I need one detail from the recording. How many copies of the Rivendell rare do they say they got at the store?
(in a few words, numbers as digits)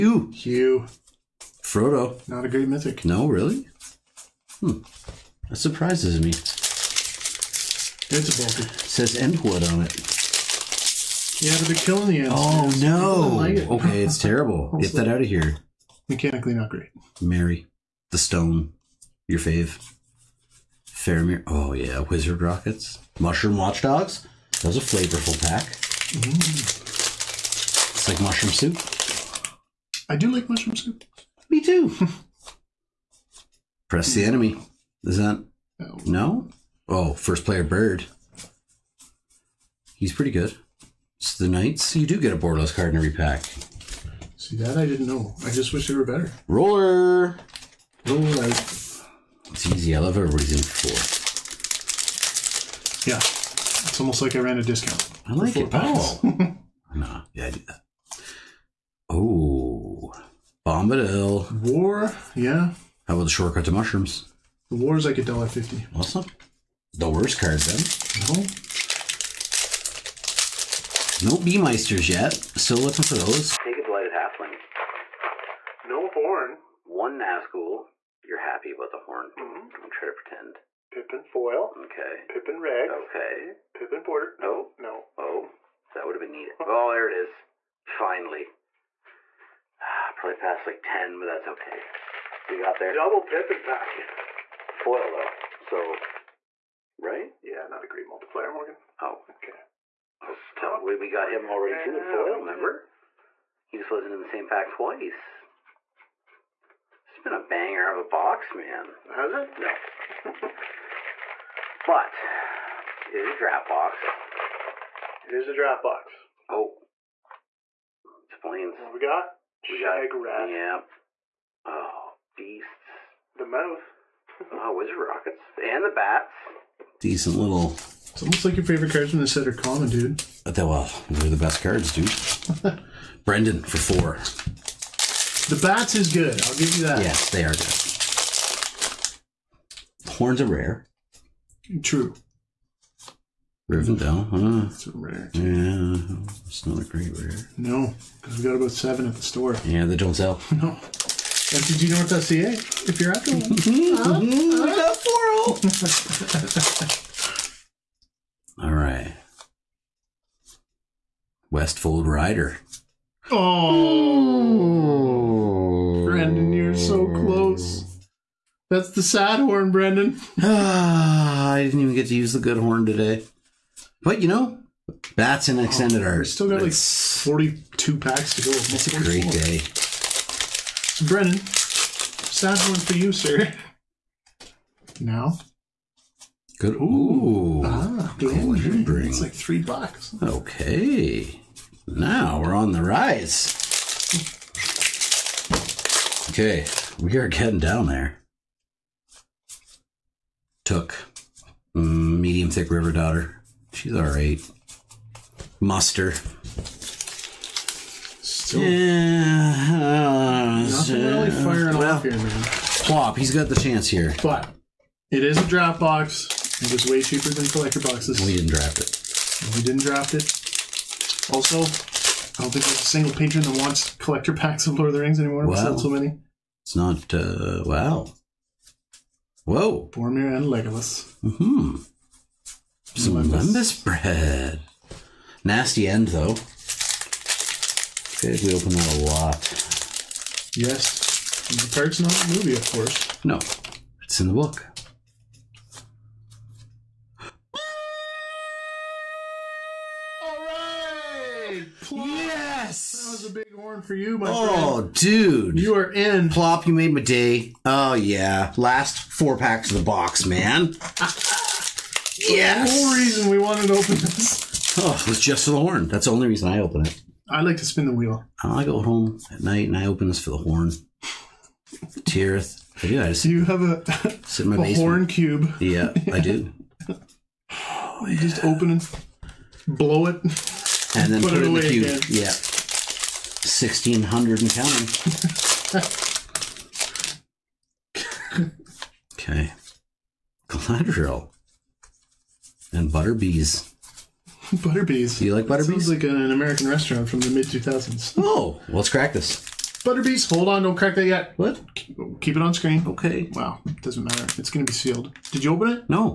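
about 7.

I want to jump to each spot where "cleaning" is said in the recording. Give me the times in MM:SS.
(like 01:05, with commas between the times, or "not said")
not said.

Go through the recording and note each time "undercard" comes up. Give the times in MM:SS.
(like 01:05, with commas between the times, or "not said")
not said.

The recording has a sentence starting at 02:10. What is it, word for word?
But uh, they, well, they're the best cards, dude.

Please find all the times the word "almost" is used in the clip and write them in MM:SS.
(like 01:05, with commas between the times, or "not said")
00:53, 02:08.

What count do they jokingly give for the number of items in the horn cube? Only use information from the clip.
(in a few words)
1,600.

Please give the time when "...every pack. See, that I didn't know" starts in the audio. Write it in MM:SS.
00:42.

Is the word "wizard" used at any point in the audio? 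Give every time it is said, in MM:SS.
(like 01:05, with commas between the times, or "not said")
00:21, 02:04.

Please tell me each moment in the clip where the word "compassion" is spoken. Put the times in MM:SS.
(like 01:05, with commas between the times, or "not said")
not said.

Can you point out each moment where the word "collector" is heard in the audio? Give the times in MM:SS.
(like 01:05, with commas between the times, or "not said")
03:37, 03:43.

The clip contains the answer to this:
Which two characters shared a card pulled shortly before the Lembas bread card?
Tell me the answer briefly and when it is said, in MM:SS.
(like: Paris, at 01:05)
Boromir and Legolas, at 03:49.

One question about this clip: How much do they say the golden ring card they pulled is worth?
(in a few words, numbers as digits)
3 bucks.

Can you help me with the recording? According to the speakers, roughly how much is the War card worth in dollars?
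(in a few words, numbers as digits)
$1.50.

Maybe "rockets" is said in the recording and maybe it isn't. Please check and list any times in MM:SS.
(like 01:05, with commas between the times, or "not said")
00:22, 02:04.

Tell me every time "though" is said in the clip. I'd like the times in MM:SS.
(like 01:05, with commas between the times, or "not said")
01:34, 03:56.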